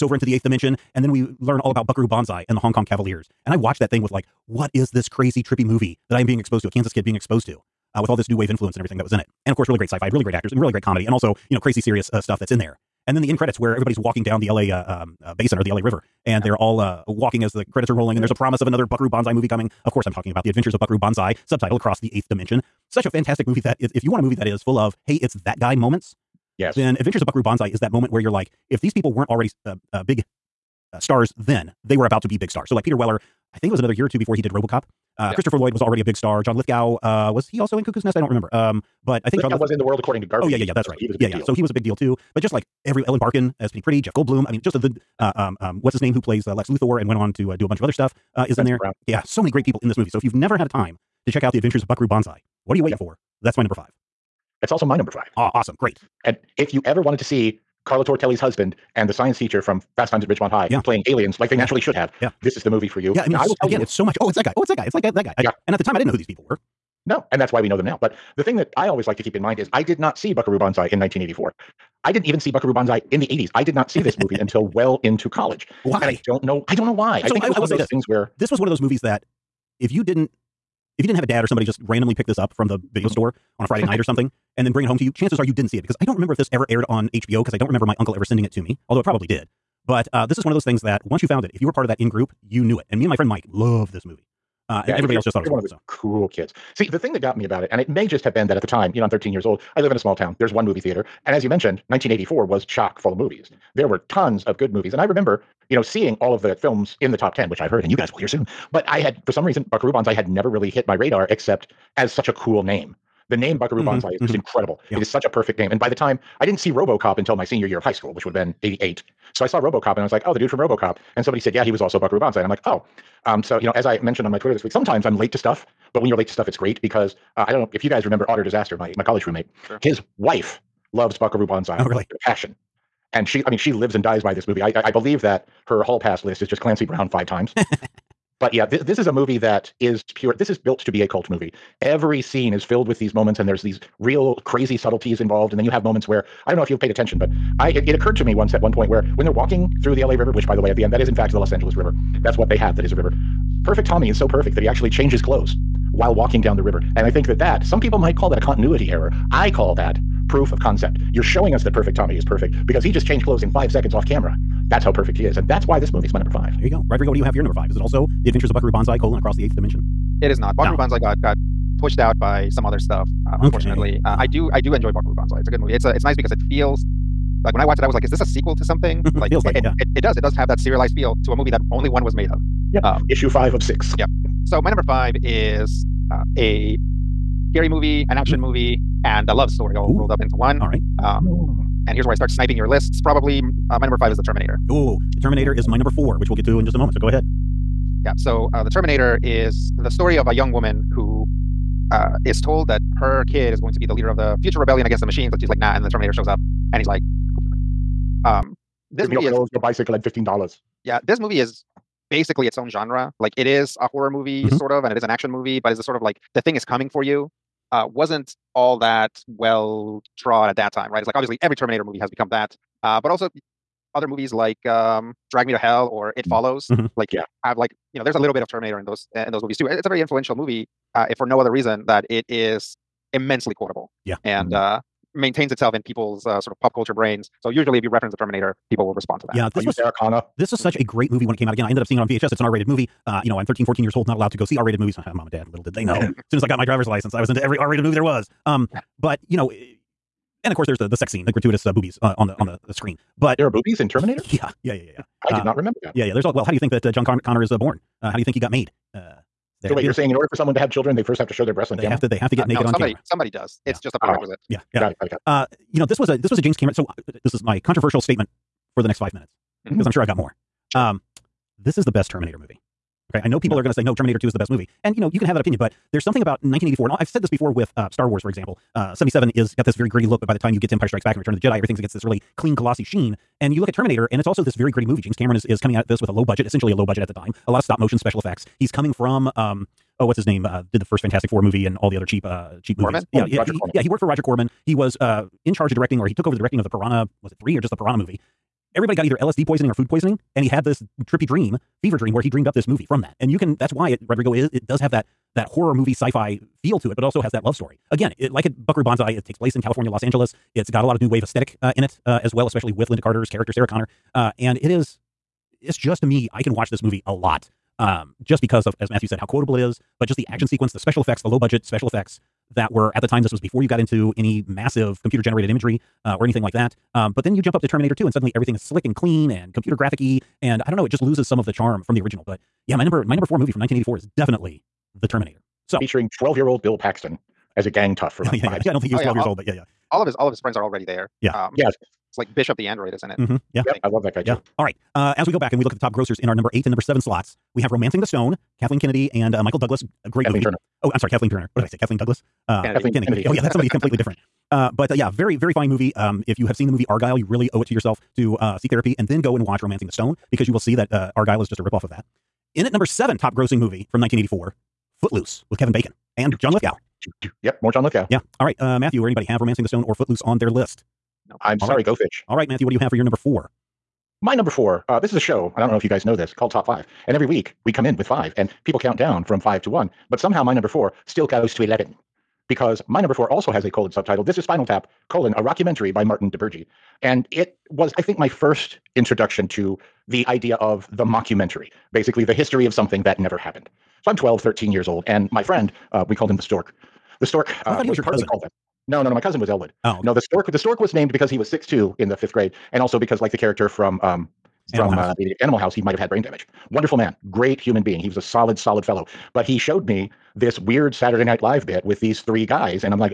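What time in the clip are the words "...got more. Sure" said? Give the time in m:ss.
4:30.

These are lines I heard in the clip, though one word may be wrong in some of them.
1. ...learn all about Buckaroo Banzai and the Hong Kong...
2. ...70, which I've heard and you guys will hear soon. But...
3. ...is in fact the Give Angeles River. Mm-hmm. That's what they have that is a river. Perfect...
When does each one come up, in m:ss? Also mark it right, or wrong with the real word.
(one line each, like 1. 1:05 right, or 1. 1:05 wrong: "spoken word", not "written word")
1. 0:01 right
2. 1:47 wrong: "10", not "70"
3. 2:30 wrong: "Los", not "Give".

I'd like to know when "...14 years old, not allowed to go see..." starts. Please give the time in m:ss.
4:03.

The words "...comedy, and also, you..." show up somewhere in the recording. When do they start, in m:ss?
0:10.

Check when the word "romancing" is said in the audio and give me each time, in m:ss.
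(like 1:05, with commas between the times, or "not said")
5:47, 5:59, 6:09.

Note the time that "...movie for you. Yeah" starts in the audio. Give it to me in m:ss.
1:02.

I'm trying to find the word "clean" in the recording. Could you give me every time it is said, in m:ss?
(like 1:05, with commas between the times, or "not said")
4:42, 5:28.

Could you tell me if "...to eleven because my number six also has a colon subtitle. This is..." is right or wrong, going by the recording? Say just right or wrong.
wrong.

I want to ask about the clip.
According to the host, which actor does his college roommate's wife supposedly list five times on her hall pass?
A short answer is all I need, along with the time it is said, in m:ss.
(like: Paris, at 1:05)
Clancy Brown, at 2:16.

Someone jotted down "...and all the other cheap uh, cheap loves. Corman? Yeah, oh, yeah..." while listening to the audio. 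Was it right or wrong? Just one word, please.
wrong.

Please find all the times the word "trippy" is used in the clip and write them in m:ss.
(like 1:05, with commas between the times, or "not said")
0:05, 5:01.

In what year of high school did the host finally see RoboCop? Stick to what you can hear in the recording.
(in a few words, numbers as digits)
88.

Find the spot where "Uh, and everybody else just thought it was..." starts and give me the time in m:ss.
1:34.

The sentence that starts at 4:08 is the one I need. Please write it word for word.
Um, but you know, eh, and of course, there's the the sex scene, the gratuitous uh, boobies uh, on the on mm-hmm.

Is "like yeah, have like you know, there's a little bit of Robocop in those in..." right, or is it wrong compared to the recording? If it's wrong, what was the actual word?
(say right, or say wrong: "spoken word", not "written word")
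wrong: "Terminator", not "Robocop".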